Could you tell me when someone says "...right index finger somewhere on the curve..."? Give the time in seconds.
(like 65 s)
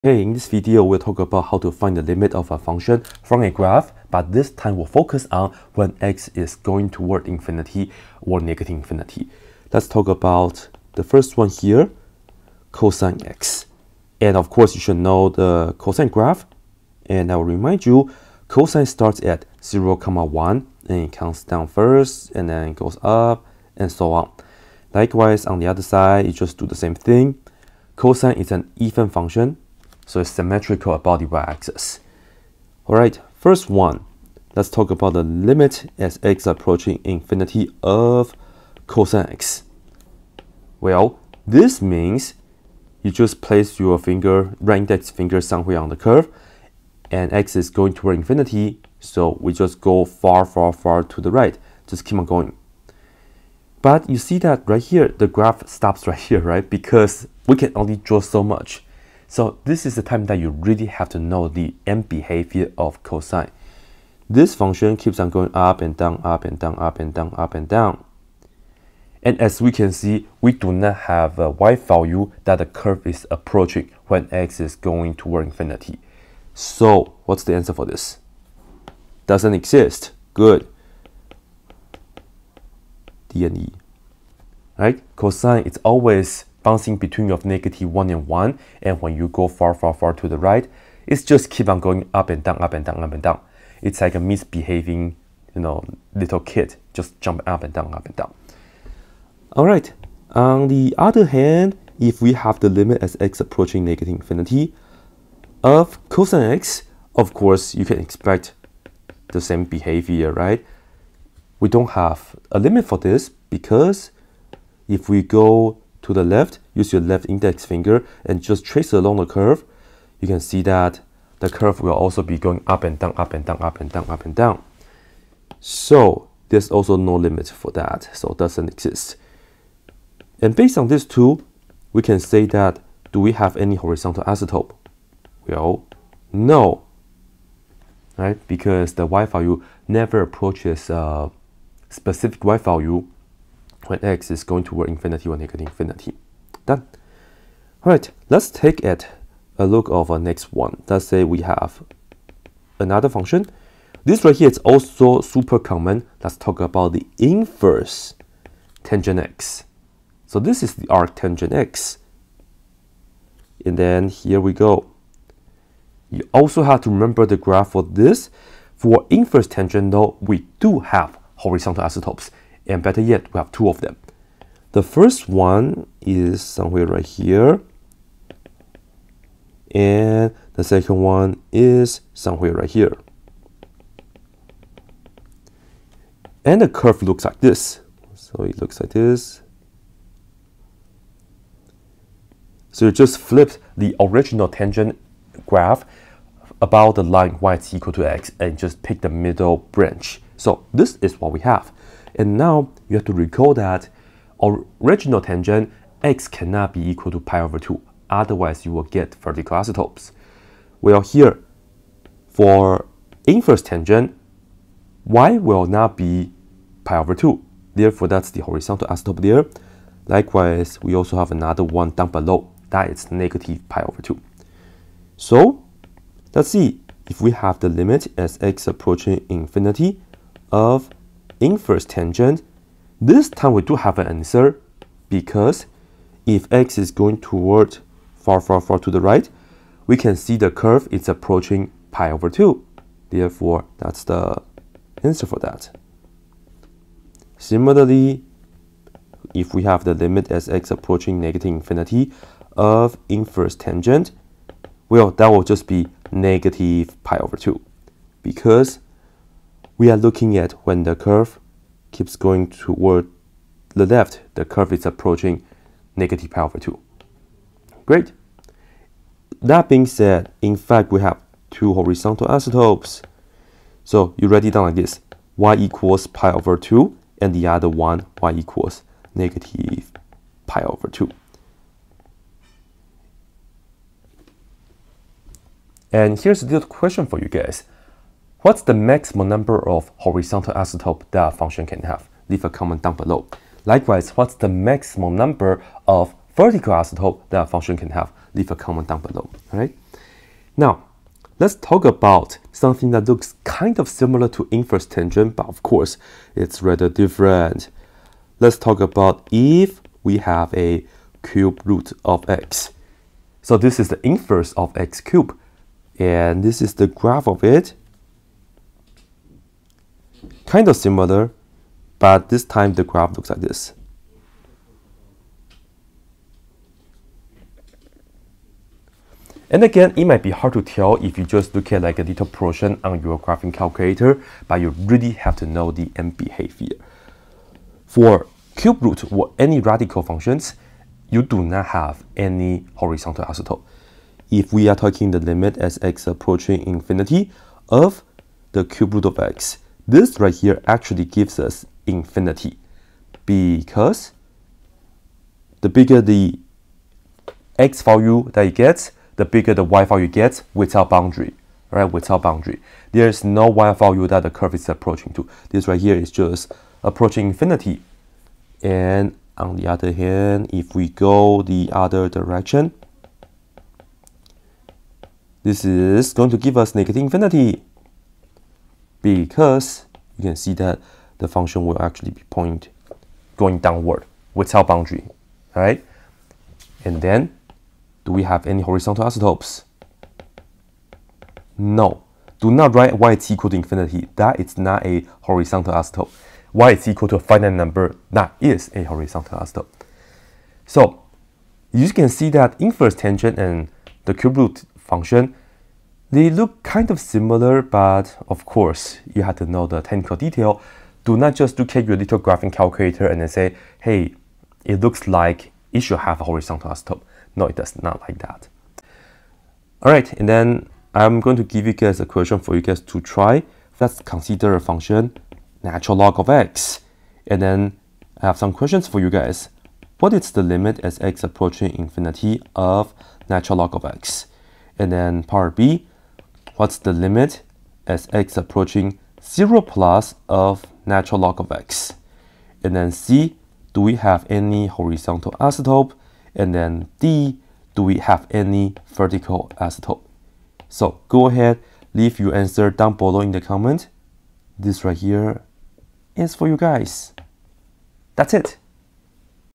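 44 s.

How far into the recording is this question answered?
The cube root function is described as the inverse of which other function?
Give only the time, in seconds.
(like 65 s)
314 s.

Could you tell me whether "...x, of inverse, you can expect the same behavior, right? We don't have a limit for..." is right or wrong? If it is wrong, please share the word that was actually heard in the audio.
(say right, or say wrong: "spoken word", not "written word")
wrong: "course", not "inverse".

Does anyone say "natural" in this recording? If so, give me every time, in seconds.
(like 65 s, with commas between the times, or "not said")
425 s, 433 s, 440 s.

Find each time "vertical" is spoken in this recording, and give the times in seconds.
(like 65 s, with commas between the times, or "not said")
209 s, 296 s, 448 s.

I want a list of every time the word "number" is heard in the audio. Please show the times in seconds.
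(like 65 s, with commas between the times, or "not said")
289 s, 295 s, 397 s.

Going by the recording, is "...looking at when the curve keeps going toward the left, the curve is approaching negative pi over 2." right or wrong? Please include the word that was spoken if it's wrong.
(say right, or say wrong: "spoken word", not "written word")
right.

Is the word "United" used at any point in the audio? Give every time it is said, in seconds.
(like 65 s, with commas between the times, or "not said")
not said.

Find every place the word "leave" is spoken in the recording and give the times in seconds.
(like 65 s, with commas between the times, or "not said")
292 s, 298 s, 451 s.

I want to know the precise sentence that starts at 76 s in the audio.
So what's the answer for this?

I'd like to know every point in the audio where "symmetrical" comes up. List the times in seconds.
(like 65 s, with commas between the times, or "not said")
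30 s.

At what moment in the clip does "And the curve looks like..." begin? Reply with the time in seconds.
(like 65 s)
186 s.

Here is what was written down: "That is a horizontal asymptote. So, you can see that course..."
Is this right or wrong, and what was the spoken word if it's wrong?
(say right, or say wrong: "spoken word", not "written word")
wrong: "inverse", not "course".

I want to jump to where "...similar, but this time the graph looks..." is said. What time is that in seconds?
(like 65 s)
320 s.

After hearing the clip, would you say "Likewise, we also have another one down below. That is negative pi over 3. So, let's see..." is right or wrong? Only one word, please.
wrong.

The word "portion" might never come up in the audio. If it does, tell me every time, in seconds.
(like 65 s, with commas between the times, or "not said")
332 s.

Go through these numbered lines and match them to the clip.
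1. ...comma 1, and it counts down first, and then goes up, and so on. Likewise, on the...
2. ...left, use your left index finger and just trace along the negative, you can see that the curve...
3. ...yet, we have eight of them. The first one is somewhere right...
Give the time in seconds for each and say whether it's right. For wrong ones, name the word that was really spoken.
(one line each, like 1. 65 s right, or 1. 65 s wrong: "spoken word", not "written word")
1. 19 s right
2. 116 s wrong: "curve", not "negative"
3. 173 s wrong: "two", not "eight".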